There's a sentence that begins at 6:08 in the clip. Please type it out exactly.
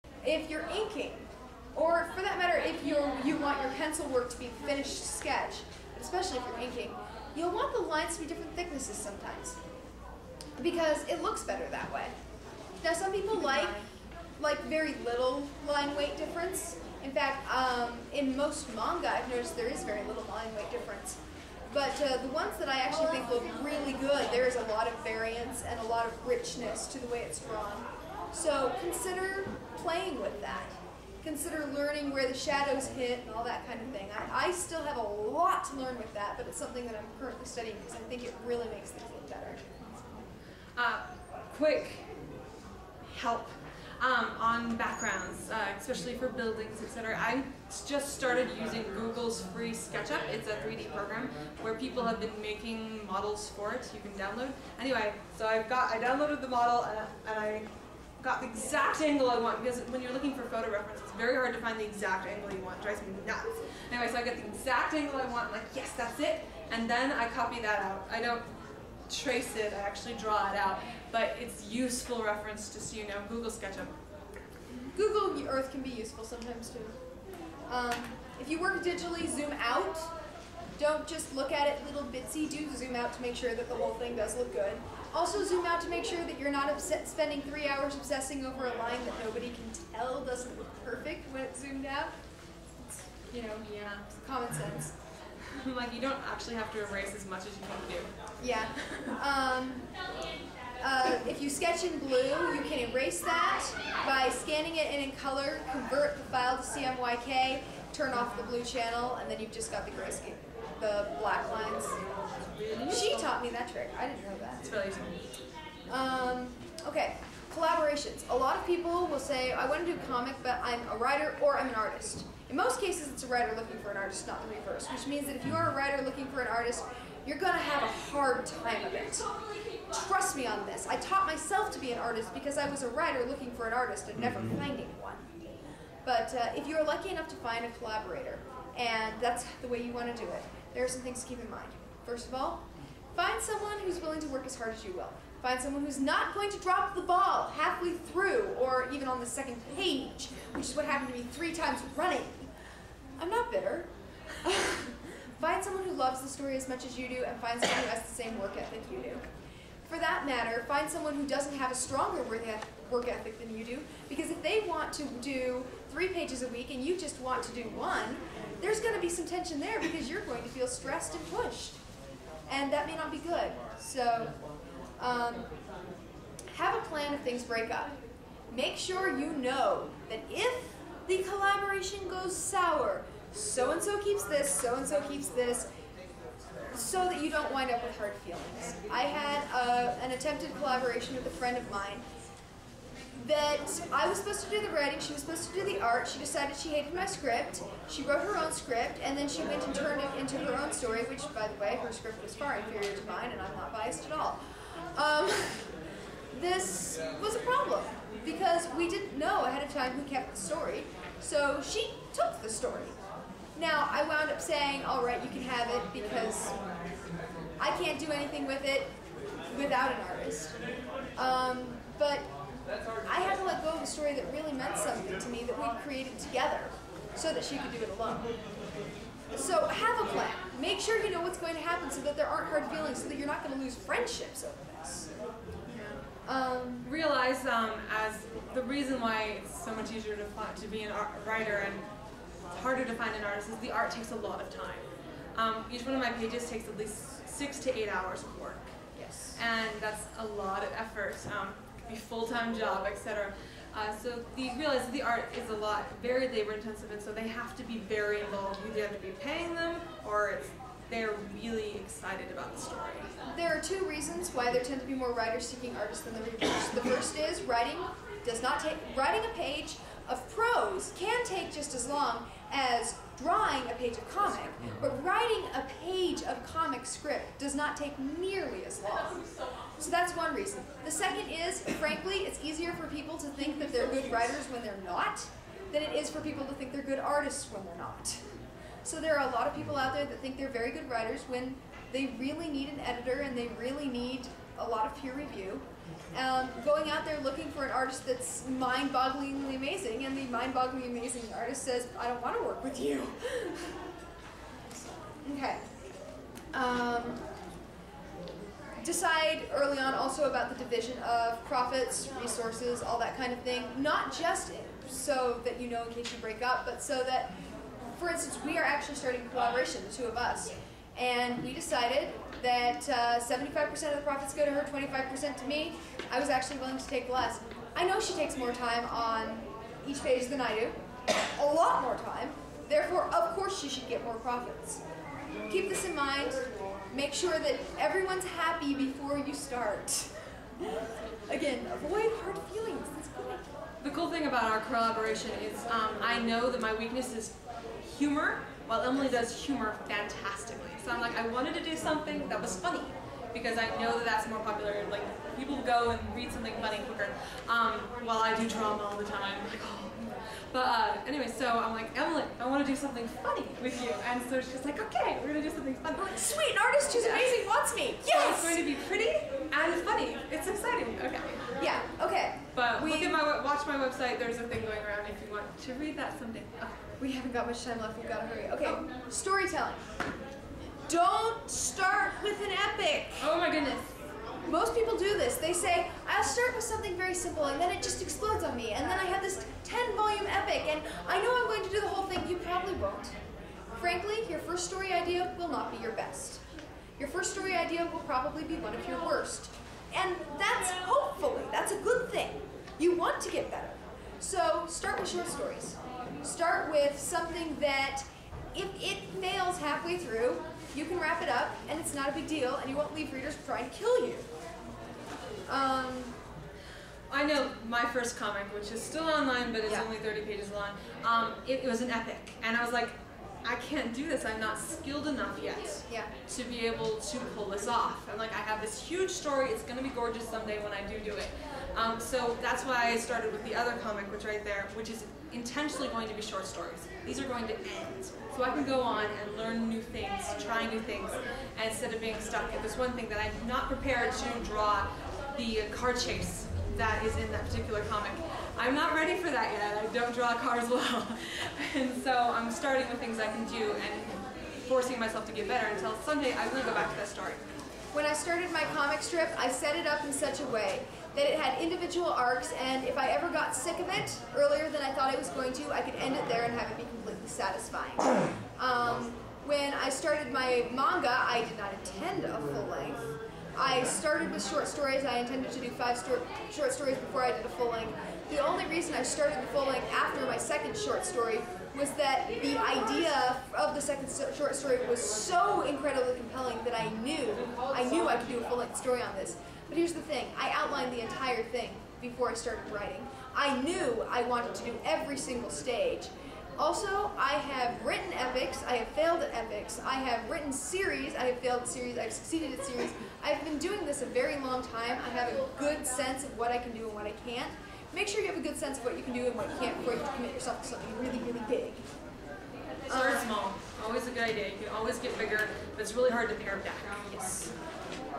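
So it's going to be pretty and funny.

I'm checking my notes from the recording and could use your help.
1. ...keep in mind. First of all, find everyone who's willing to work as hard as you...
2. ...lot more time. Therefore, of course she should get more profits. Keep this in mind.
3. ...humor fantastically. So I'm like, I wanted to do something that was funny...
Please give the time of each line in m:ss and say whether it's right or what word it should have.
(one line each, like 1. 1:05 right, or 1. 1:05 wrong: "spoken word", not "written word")
1. 2:21 wrong: "someone", not "everyone"
2. 5:31 right
3. 5:49 right.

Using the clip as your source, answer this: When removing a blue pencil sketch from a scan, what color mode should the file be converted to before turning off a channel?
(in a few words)
CMYK.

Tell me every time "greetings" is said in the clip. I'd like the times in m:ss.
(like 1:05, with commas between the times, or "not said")
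not said.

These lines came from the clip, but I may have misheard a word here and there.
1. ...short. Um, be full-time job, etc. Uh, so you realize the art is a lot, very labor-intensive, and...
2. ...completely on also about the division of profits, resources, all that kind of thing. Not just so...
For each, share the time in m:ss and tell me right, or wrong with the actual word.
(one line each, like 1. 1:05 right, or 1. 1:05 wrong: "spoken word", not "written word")
1. 4:10 wrong: "effort", not "short"
2. 5:09 wrong: "early", not "completely".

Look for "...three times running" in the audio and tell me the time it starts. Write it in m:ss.
2:31.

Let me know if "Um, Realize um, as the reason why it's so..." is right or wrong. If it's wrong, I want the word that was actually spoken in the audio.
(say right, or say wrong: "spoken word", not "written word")
right.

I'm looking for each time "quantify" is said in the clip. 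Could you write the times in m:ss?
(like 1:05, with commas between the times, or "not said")
not said.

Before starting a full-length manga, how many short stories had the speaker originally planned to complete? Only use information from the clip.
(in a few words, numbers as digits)
5.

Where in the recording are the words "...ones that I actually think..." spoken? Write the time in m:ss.
0:22.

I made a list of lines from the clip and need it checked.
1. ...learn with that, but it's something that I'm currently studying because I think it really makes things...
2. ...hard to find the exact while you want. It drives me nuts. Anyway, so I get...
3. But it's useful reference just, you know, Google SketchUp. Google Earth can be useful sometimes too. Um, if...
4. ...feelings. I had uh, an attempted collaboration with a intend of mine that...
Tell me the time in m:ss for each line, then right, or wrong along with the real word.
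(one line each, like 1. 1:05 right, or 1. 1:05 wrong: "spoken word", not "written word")
1. 0:35 right
2. 1:01 wrong: "angle", not "while"
3. 1:11 right
4. 3:08 wrong: "friend", not "intend".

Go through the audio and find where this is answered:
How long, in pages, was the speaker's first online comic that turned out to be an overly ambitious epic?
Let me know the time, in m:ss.
6:59.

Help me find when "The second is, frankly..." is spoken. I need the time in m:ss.
4:40.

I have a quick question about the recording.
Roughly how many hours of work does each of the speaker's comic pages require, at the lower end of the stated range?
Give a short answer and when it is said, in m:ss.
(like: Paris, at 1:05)
6, at 4:07.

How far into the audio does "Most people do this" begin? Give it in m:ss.
6:24.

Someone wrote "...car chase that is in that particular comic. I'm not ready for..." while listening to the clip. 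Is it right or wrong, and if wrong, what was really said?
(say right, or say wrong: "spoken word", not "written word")
right.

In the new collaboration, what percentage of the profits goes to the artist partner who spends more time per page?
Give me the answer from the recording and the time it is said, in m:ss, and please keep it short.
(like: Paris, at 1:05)
75%, at 5:22.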